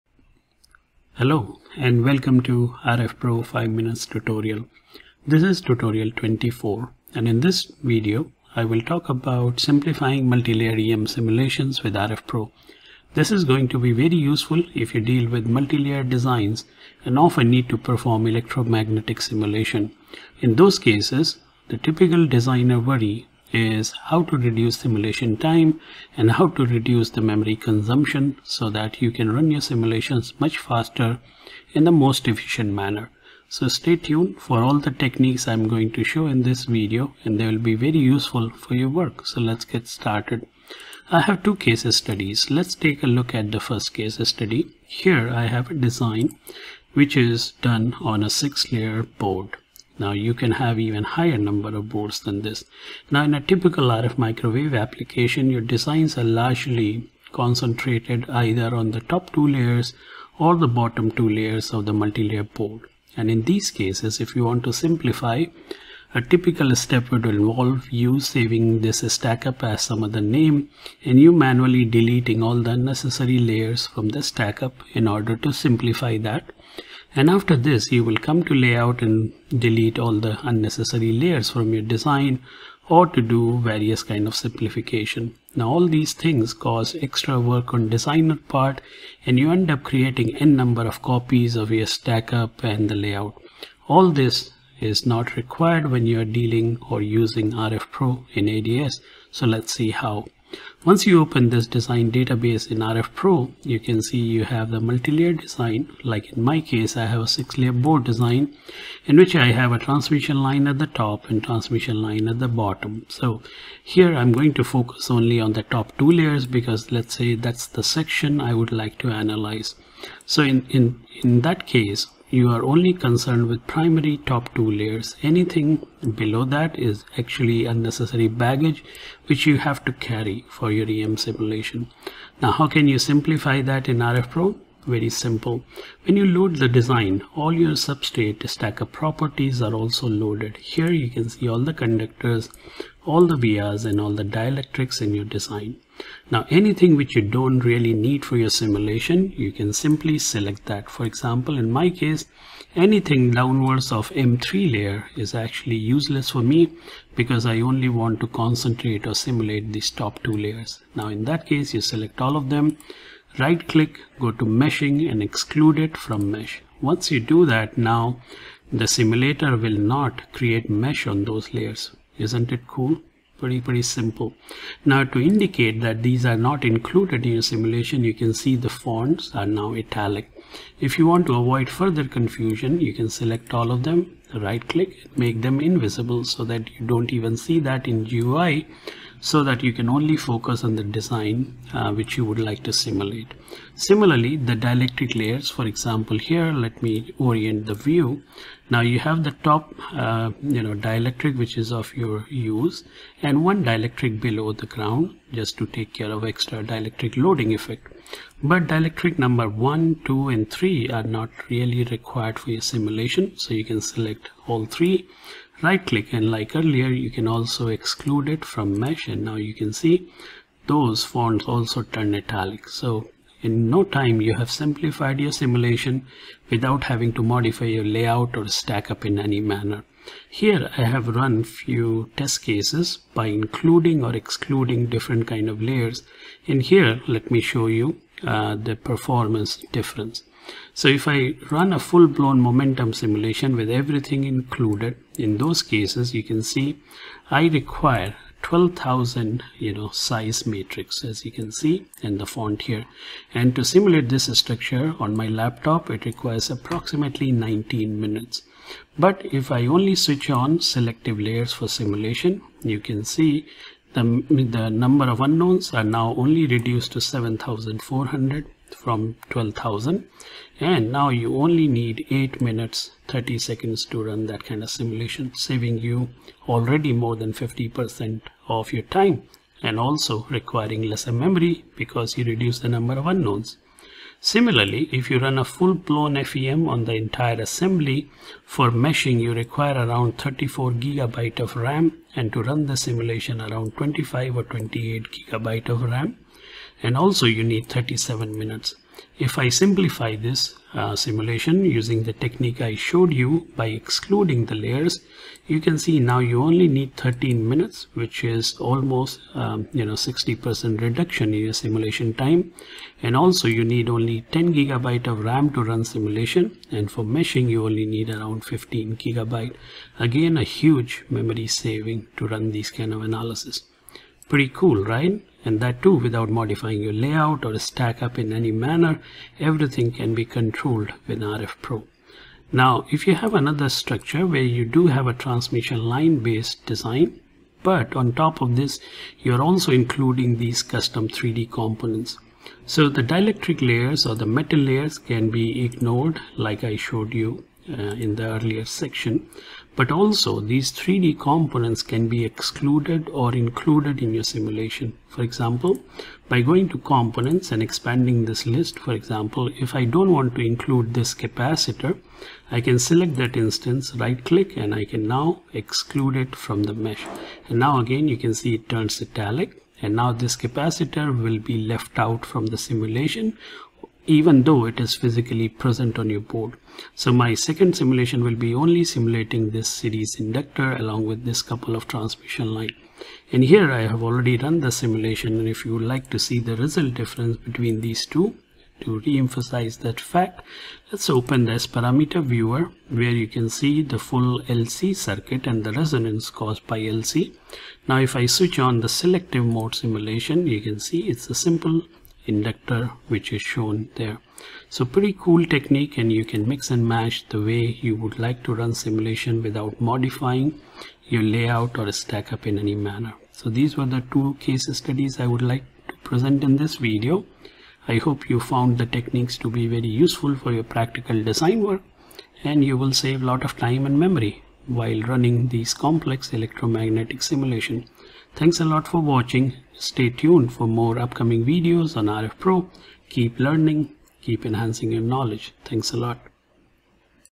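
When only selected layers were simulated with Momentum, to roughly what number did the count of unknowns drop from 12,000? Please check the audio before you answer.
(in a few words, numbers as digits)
7400.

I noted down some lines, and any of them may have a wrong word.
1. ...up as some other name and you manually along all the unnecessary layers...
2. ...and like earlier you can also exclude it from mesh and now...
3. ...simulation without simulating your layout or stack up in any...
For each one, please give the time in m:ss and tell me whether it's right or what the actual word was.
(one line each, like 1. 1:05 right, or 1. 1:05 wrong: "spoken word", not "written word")
1. 1:09 wrong: "deleting", not "along"
2. 3:36 right
3. 6:48 wrong: "modifying", not "simulating".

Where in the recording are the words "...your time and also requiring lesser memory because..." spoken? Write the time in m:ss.
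4:38.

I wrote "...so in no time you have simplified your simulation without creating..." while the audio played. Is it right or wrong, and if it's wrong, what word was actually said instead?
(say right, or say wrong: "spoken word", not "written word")
wrong: "having", not "creating".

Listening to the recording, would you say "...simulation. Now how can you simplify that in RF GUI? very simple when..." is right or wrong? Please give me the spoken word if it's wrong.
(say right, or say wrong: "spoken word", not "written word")
wrong: "Pro", not "GUI".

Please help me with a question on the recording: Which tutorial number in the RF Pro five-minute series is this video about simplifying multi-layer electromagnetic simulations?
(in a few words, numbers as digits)
24.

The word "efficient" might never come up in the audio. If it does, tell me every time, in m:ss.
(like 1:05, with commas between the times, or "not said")
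0:32.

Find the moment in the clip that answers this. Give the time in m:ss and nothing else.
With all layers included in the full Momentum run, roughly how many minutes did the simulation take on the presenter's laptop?
4:17.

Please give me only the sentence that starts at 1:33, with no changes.
All this is not required when you are dealing or using RF Pro in ADS.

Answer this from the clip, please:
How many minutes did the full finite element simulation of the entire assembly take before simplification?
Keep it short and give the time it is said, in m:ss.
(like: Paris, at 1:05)
37 minutes, at 4:57.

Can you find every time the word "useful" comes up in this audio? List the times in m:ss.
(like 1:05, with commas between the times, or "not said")
0:14, 0:37, 7:00.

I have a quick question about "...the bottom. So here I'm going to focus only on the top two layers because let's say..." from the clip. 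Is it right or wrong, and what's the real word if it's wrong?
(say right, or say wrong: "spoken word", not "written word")
right.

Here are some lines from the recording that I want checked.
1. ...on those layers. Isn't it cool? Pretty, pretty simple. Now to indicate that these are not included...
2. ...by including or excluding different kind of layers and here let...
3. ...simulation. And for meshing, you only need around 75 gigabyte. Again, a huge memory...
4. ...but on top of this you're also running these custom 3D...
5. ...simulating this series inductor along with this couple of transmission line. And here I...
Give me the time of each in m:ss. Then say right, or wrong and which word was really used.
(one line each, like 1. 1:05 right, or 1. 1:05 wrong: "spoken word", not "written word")
1. 2:51 right
2. 3:53 right
3. 5:15 wrong: "15", not "75"
4. 5:37 wrong: "including", not "running"
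5. 6:18 right.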